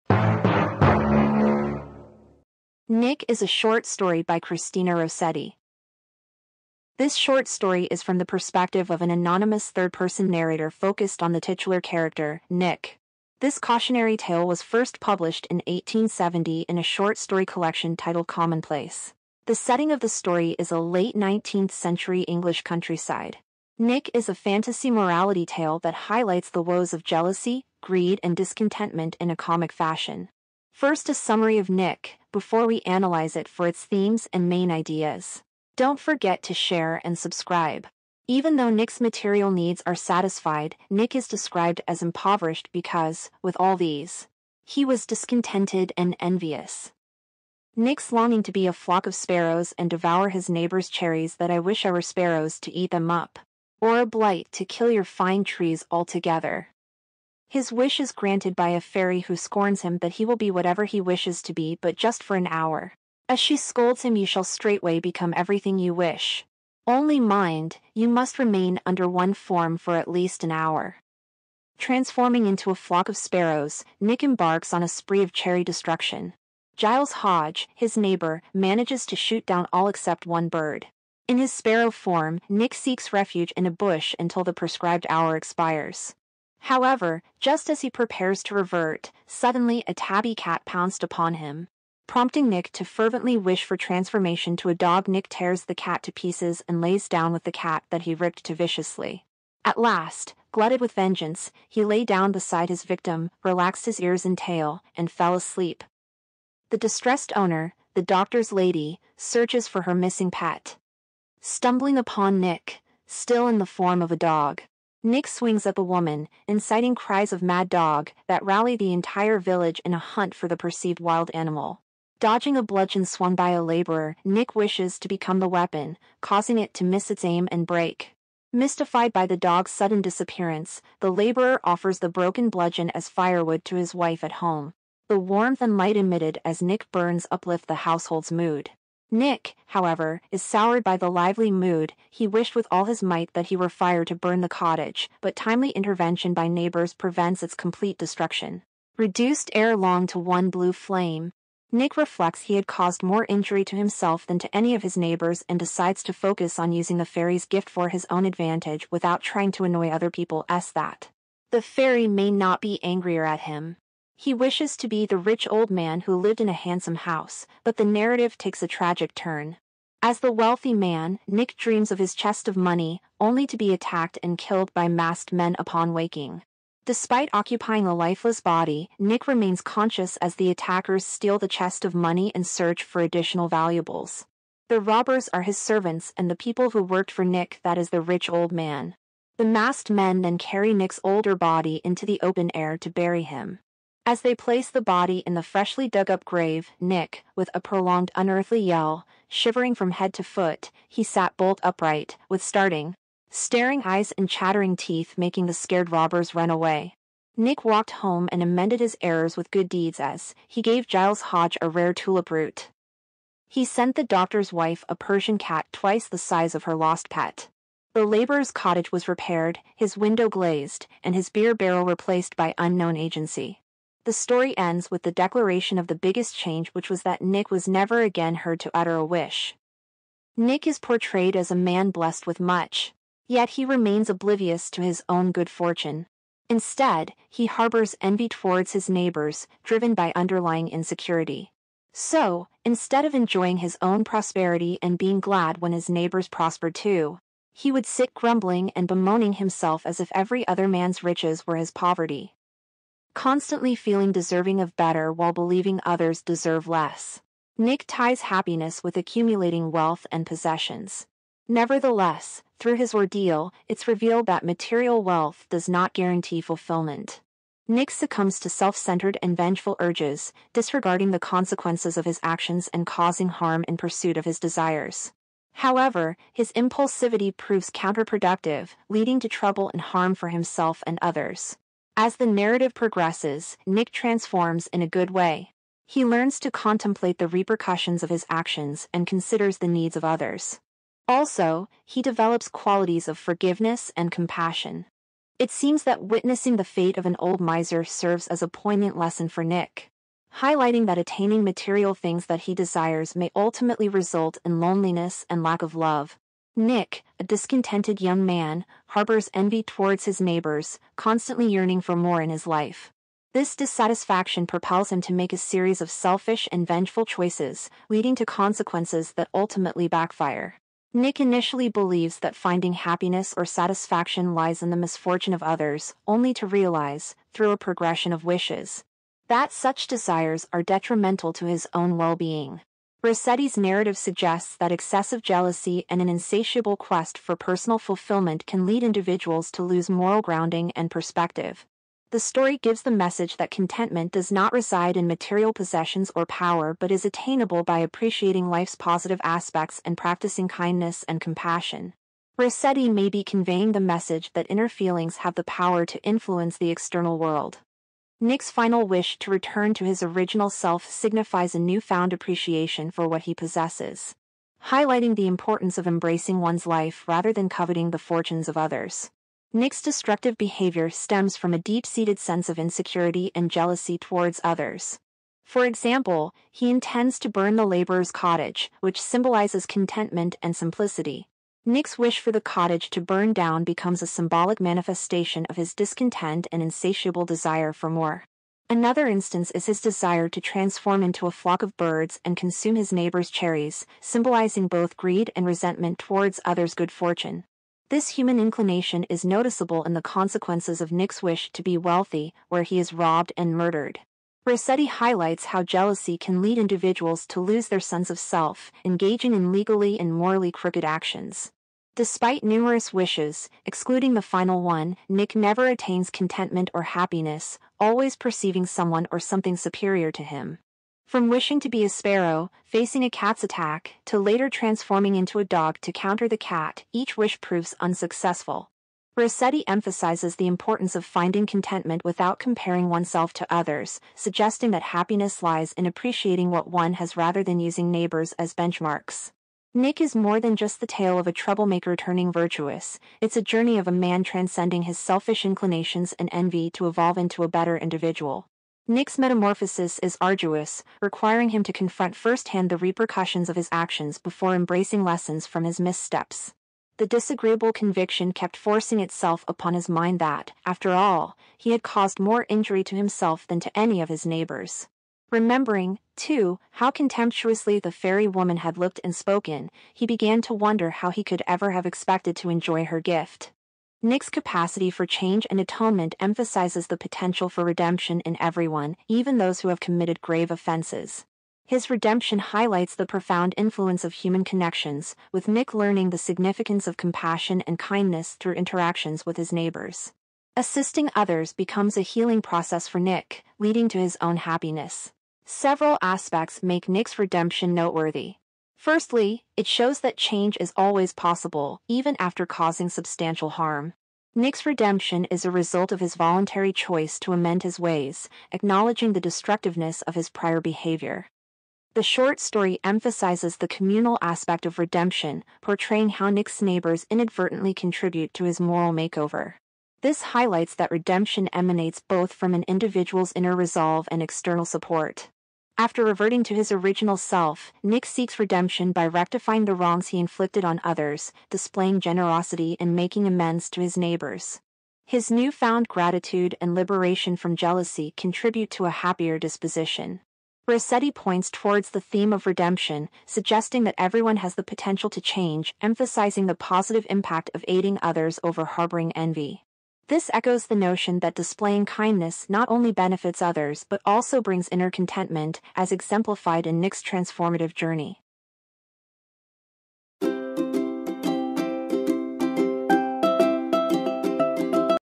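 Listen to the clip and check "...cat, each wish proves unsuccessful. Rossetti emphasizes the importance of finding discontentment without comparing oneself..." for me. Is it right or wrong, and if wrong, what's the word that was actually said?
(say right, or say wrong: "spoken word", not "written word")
wrong: "contentment", not "discontentment".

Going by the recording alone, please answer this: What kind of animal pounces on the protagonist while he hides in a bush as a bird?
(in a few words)
tabby cat.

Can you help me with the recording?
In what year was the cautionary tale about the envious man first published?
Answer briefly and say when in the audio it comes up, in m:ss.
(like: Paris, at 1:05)
1870, at 0:15.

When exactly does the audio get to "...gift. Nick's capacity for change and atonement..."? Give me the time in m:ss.
7:53.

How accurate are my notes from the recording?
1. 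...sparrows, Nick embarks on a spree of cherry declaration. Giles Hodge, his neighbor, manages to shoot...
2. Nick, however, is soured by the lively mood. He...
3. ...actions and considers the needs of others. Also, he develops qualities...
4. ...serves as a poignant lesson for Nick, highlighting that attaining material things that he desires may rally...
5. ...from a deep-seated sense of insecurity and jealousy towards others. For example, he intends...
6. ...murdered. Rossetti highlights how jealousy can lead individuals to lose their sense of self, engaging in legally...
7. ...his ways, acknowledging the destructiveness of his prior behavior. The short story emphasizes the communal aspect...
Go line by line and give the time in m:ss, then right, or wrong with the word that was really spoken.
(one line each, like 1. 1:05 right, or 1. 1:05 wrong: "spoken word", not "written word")
1. 1:13 wrong: "destruction", not "declaration"
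2. 2:19 right
3. 4:48 right
4. 4:57 wrong: "ultimately", not "rally"
5. 6:11 right
6. 6:43 right
7. 8:27 right.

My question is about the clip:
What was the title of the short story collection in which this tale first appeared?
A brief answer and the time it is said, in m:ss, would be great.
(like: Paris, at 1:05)
Commonplace, at 0:18.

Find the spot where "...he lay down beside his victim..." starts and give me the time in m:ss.
1:41.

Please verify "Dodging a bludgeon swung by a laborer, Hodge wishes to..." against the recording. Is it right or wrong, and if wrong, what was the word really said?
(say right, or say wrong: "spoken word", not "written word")
wrong: "Nick", not "Hodge".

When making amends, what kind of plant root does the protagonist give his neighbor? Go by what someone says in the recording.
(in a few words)
tulip root.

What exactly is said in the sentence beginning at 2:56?
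Despite occupying a lifeless body, Nick remains conscious as the attackers steal the chest of money and search for additional valuables.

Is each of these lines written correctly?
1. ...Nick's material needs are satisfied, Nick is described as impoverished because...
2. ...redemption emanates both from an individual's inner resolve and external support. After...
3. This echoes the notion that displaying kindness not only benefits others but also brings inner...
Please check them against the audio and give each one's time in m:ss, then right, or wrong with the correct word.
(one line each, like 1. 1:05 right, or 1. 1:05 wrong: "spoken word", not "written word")
1. 0:38 right
2. 8:40 right
3. 9:10 right.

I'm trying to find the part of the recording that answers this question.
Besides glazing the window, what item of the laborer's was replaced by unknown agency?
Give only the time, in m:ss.
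3:41.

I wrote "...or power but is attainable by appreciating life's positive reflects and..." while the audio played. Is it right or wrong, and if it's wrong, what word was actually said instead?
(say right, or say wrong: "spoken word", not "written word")
wrong: "aspects", not "reflects".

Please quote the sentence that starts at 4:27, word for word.
Nick succumbs to self-centered and vengeful urges, disregarding the consequences of his actions and causing harm in pursuit of his desires.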